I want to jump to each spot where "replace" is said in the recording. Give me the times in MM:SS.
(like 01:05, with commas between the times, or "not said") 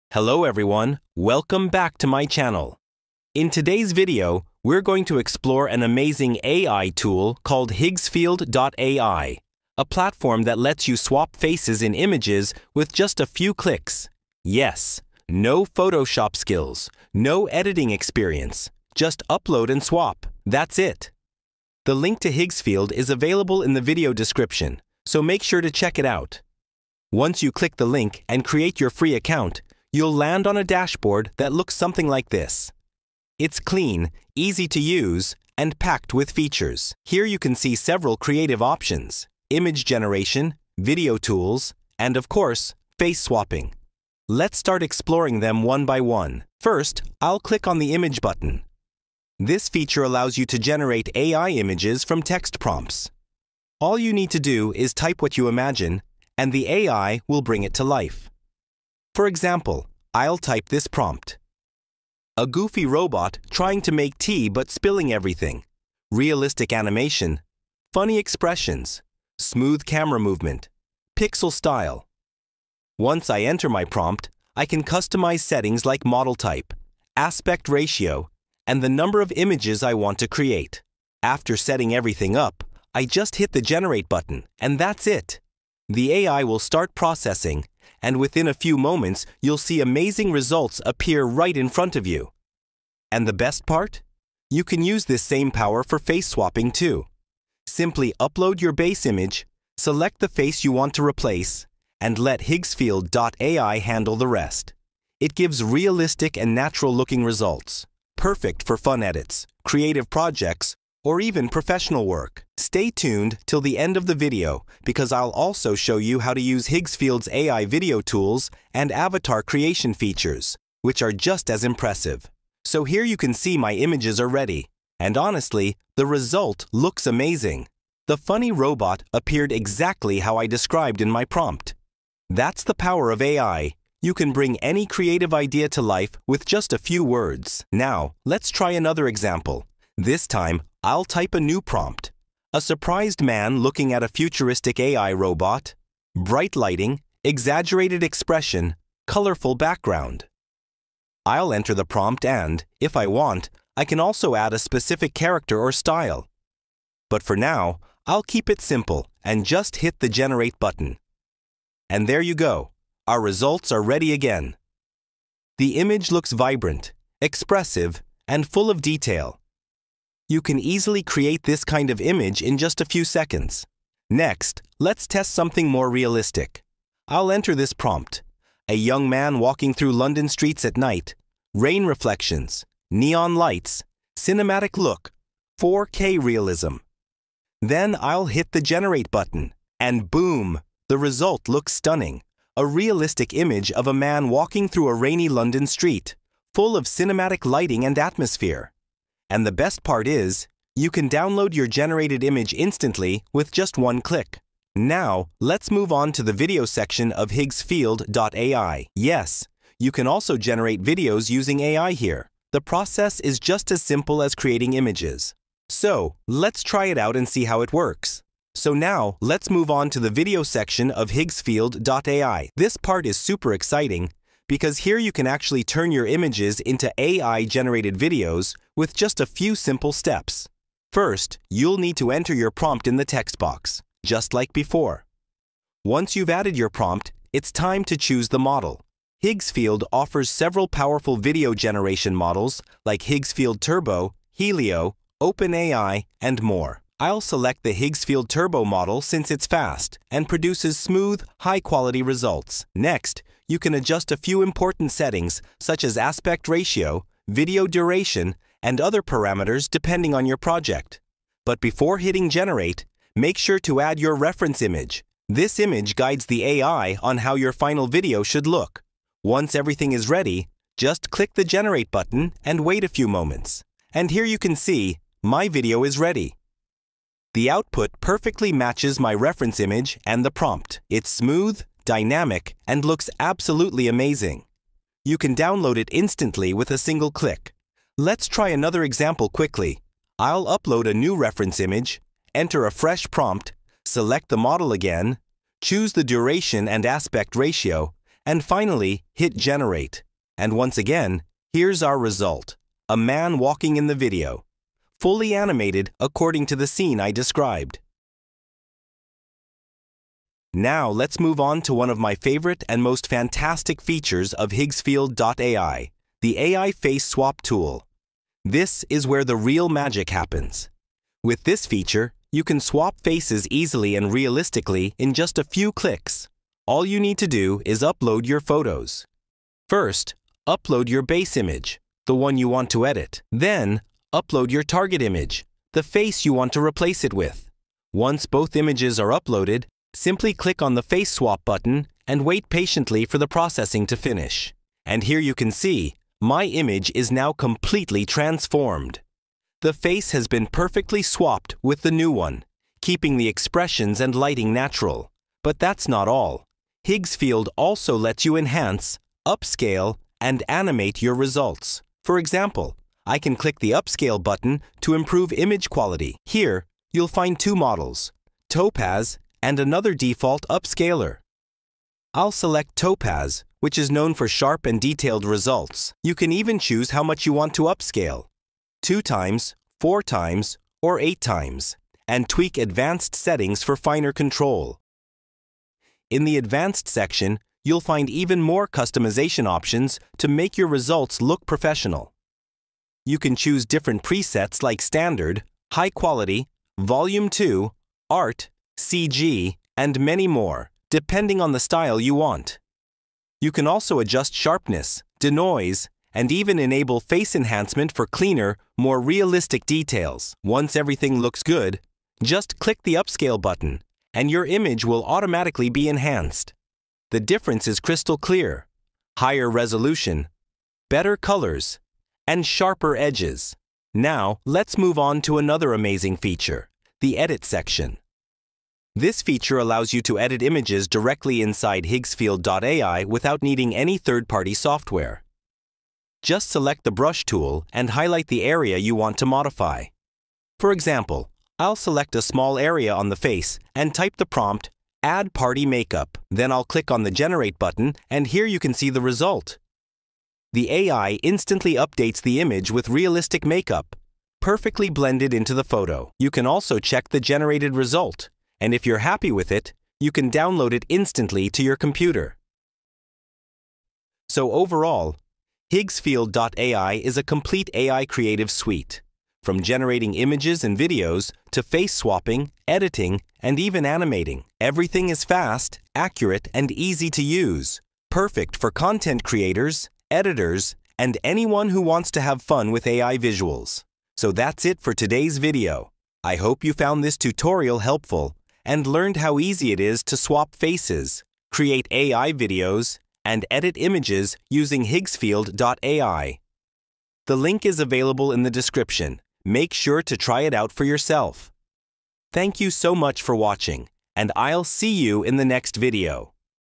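01:41, 05:36.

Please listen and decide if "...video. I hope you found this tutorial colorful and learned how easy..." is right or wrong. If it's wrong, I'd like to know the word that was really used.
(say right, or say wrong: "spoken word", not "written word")
wrong: "helpful", not "colorful".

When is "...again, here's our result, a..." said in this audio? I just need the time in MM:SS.
05:00.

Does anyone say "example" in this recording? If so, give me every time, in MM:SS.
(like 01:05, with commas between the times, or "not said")
00:59, 02:19, 04:48, 06:02, 07:20.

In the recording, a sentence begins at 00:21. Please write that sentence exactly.
The link to Higgsfield is available in the video description, so make sure to check it out.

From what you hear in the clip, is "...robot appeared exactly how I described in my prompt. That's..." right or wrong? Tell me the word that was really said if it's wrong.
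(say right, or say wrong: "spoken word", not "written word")
right.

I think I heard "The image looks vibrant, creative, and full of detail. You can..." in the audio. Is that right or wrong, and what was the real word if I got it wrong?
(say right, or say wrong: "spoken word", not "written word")
wrong: "expressive", not "creative".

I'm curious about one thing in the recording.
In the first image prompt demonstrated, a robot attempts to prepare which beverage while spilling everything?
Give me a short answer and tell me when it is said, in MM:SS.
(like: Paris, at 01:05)
Tea, at 01:04.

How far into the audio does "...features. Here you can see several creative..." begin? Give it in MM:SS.
00:36.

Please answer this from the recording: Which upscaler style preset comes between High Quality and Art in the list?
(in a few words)
Volume 2.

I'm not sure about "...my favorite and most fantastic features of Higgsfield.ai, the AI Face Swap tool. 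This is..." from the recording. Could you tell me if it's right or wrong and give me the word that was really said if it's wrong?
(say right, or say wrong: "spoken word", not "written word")
right.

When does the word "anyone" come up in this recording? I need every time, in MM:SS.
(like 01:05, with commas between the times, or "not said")
08:01.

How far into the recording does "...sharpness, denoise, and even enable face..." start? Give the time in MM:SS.
06:44.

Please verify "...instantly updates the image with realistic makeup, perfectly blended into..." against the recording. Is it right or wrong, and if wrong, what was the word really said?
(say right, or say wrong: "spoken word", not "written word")
right.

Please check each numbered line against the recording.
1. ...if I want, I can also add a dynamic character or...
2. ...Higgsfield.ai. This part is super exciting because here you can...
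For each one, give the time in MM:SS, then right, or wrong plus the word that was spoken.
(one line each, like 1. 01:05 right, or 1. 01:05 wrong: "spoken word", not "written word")
1. 02:32 wrong: "specific", not "dynamic"
2. 03:41 right.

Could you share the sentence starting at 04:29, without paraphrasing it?
Once everything is ready, just click the Generate button and wait a few moments.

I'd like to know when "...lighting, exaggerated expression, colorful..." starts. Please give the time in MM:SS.
02:26.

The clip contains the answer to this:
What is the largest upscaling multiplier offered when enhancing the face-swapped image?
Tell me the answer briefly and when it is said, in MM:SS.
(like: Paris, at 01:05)
8 times, at 06:20.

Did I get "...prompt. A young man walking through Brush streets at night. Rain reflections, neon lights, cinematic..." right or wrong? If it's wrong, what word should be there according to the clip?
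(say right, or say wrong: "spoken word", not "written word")
wrong: "London", not "Brush".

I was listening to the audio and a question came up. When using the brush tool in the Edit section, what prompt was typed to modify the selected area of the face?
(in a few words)
Add Party Makeup.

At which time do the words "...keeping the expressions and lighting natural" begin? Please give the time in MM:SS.
05:52.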